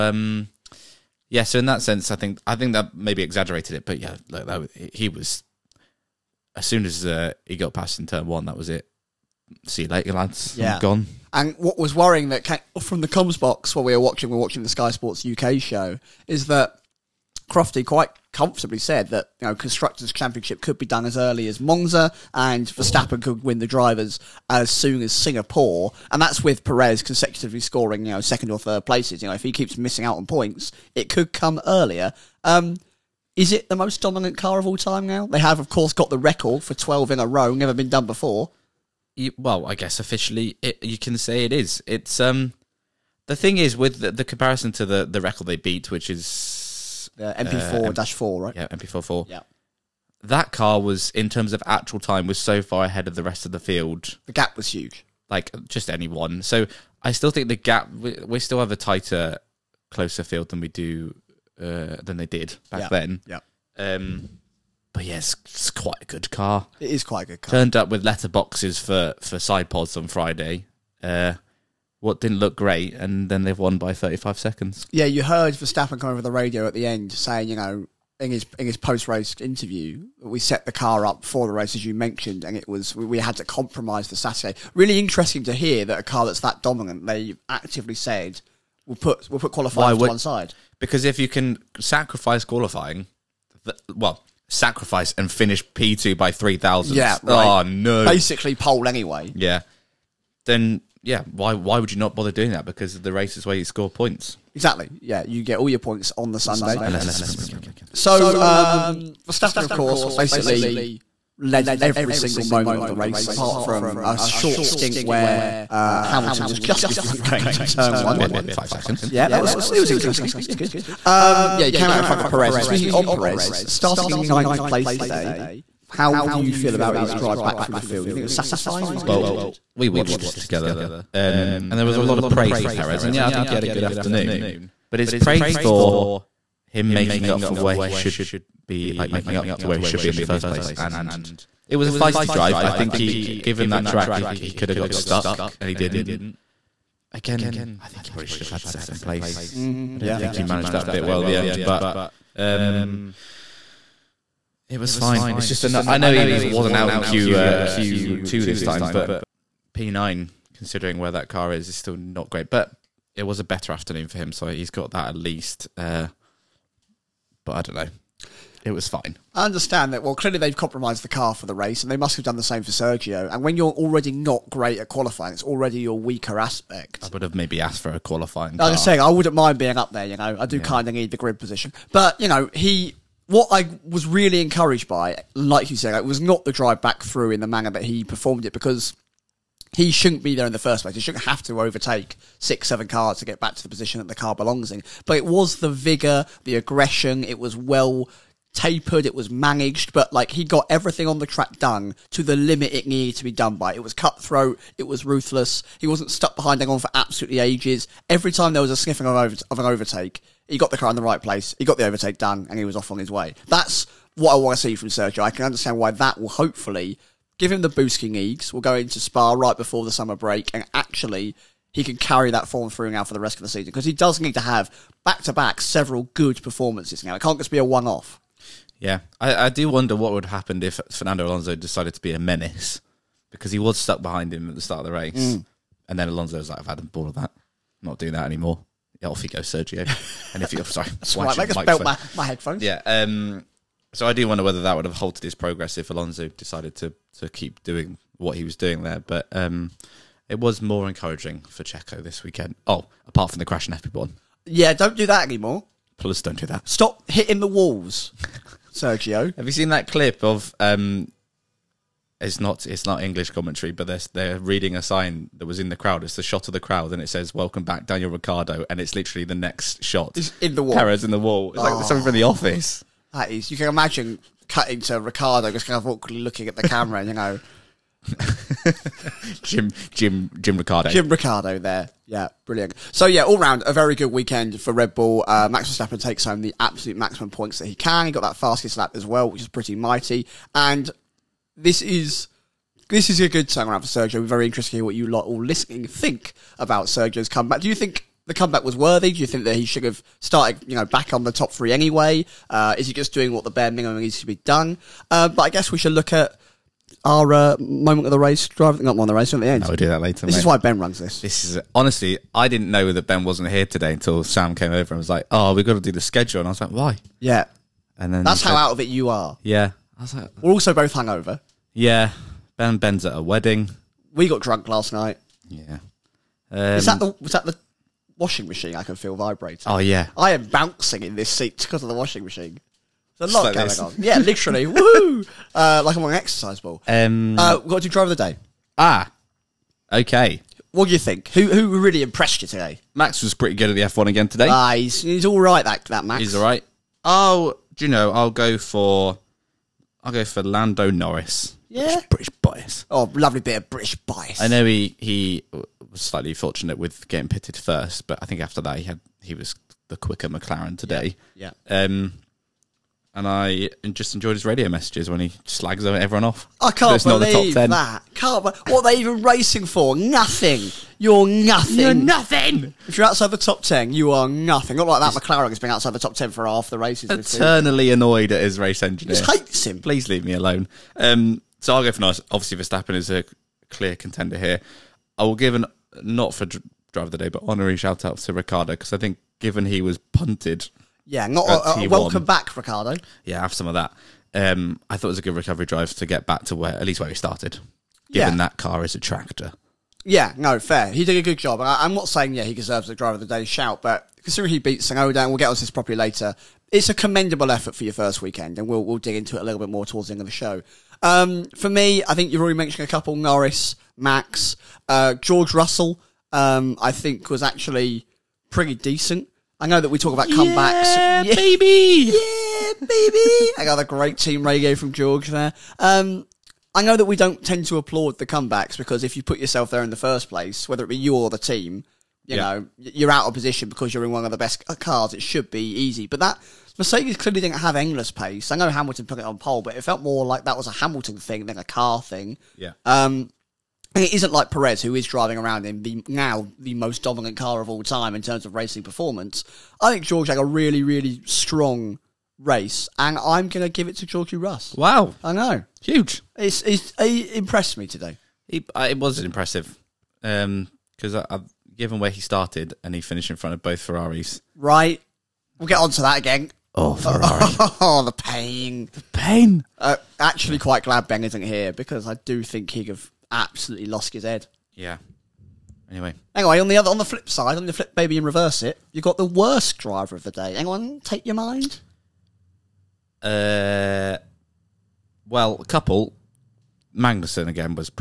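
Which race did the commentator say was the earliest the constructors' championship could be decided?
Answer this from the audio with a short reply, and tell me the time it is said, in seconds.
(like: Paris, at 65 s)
Monza, at 21 s.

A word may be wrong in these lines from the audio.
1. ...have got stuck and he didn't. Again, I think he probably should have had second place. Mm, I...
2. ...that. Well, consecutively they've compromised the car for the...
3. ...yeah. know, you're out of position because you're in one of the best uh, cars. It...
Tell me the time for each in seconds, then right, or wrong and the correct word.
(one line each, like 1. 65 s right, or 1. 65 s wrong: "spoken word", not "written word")
1. 144 s right
2. 169 s wrong: "clearly", not "consecutively"
3. 432 s right.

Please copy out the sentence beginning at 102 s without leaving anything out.
Because the race is where you score points.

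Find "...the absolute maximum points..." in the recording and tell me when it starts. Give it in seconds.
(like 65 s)
286 s.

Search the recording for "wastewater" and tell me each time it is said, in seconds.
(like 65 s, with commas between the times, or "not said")
not said.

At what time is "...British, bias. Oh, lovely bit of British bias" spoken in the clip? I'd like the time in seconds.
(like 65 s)
352 s.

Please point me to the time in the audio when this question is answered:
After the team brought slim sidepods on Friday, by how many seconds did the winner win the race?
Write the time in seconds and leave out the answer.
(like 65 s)
73 s.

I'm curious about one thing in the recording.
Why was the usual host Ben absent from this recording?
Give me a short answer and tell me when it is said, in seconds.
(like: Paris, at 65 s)
At a wedding, at 322 s.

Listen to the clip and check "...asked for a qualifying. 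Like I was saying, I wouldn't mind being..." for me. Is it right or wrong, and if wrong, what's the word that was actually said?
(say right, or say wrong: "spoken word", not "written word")
right.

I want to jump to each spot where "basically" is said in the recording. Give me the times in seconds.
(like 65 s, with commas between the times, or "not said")
98 s, 110 s.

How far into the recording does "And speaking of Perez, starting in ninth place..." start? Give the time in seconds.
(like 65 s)
122 s.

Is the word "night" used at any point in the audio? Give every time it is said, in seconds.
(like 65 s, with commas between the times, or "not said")
324 s.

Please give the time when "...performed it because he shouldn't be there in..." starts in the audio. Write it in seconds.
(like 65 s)
188 s.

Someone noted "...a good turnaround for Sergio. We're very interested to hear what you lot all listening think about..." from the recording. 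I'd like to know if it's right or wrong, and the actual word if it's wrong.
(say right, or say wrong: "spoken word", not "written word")
right.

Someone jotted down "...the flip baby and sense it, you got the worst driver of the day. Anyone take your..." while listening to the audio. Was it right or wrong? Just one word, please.
wrong.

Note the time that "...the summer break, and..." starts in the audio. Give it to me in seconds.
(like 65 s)
219 s.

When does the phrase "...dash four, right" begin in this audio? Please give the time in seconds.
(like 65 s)
47 s.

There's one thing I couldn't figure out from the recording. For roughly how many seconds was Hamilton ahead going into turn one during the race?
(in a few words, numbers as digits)
5.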